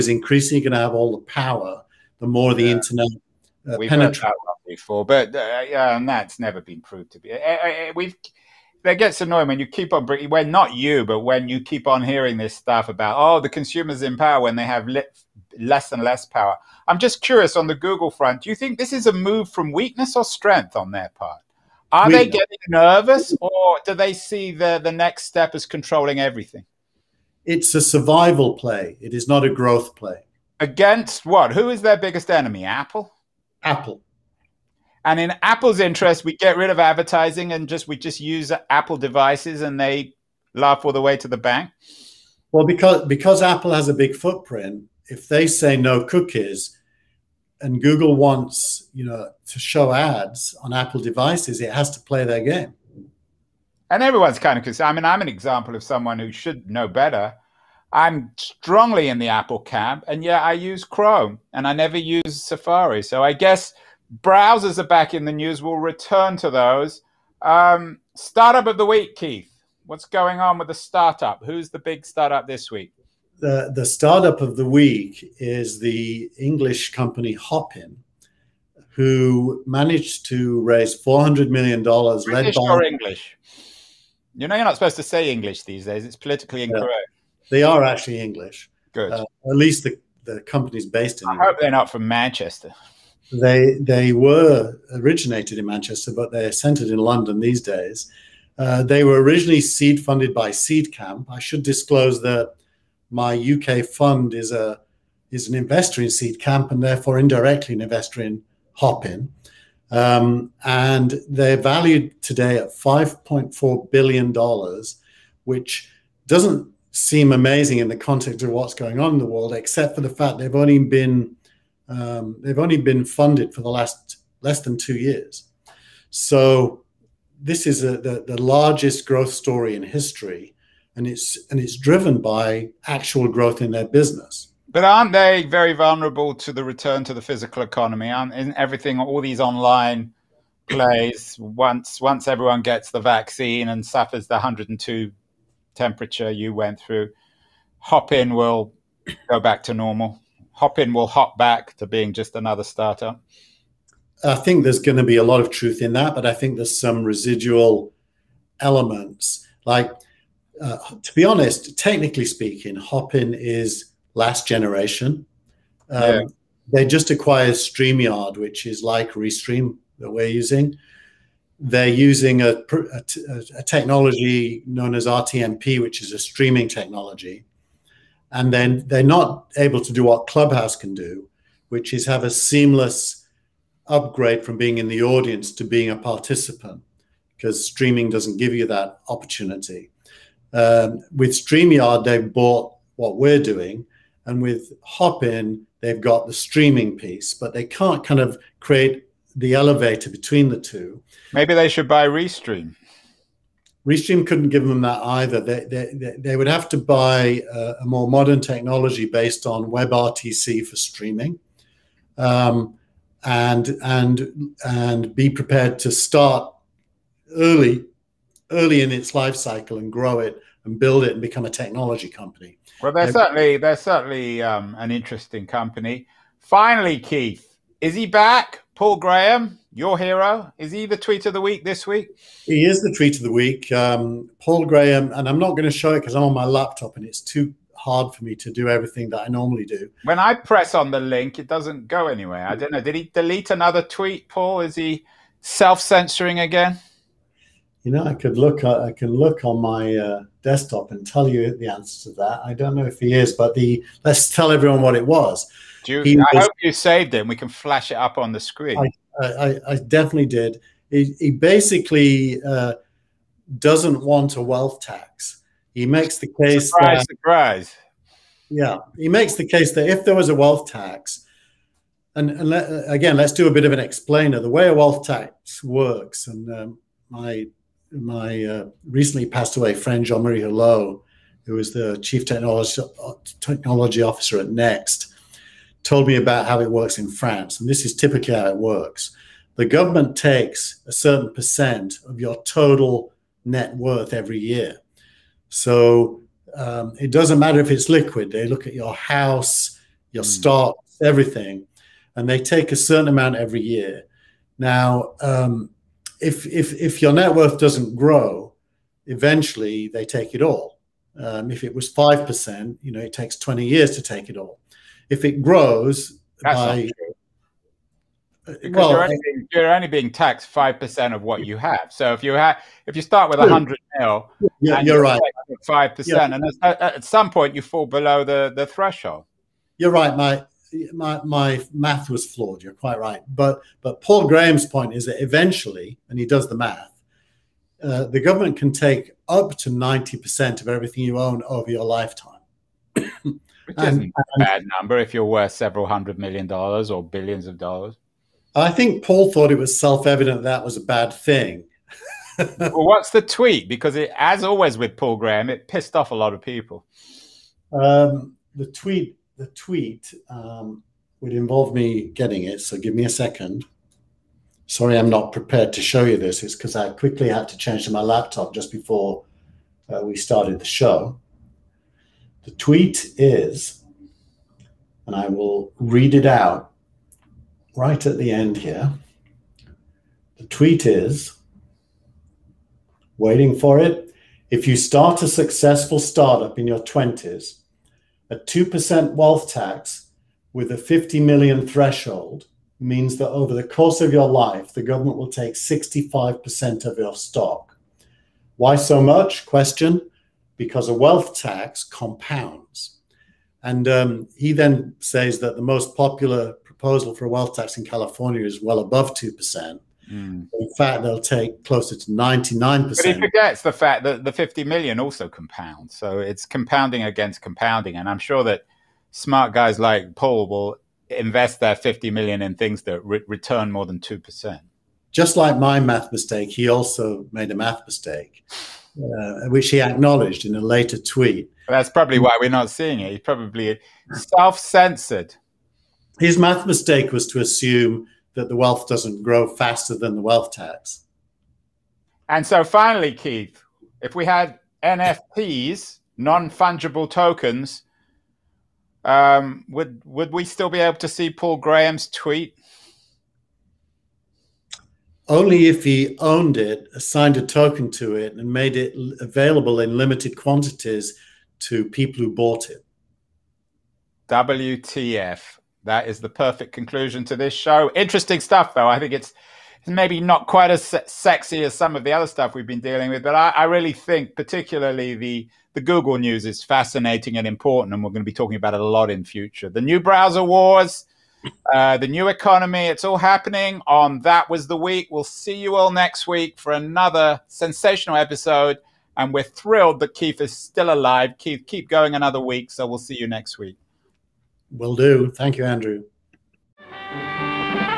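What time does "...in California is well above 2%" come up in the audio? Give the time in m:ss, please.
6:47.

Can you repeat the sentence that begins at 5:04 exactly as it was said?
Now, um, if if if your net worth doesn't grow, eventually they take it all.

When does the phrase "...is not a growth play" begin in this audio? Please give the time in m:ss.
0:29.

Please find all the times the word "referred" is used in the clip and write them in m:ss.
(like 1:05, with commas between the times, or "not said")
not said.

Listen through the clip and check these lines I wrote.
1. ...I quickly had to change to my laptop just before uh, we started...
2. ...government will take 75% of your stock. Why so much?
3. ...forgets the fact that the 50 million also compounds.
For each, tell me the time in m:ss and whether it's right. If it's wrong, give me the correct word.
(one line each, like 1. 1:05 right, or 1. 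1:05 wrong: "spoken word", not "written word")
1. 6:06 right
2. 6:34 wrong: "65", not "75"
3. 6:53 right.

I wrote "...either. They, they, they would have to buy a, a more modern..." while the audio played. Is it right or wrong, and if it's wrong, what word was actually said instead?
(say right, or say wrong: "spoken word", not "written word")
right.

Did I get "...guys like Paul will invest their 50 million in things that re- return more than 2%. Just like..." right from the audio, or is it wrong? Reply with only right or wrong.
right.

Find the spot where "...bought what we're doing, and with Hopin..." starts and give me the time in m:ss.
3:12.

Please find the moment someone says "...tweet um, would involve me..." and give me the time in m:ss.
5:59.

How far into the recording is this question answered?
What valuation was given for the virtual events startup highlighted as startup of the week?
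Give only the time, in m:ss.
1:52.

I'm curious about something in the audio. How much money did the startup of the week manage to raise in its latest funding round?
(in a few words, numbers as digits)
$400 million.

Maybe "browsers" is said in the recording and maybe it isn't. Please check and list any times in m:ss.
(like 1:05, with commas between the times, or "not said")
1:04, 7:59.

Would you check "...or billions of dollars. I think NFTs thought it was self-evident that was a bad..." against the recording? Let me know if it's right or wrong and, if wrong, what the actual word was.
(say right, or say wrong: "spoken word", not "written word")
wrong: "Paul", not "NFTs".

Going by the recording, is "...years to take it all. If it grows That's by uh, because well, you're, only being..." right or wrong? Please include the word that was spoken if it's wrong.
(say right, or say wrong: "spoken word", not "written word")
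right.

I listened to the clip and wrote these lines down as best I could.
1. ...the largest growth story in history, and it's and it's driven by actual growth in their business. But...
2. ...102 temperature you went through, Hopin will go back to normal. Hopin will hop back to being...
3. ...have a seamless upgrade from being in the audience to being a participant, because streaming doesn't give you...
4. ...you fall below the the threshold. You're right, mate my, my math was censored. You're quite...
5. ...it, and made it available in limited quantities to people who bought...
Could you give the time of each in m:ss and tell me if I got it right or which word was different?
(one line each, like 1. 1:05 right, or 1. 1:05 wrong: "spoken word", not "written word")
1. 2:08 right
2. 2:24 right
3. 3:02 right
4. 5:27 wrong: "flawed", not "censored"
5. 7:38 right.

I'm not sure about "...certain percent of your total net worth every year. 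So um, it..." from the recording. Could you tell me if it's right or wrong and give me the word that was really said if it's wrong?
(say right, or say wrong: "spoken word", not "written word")
right.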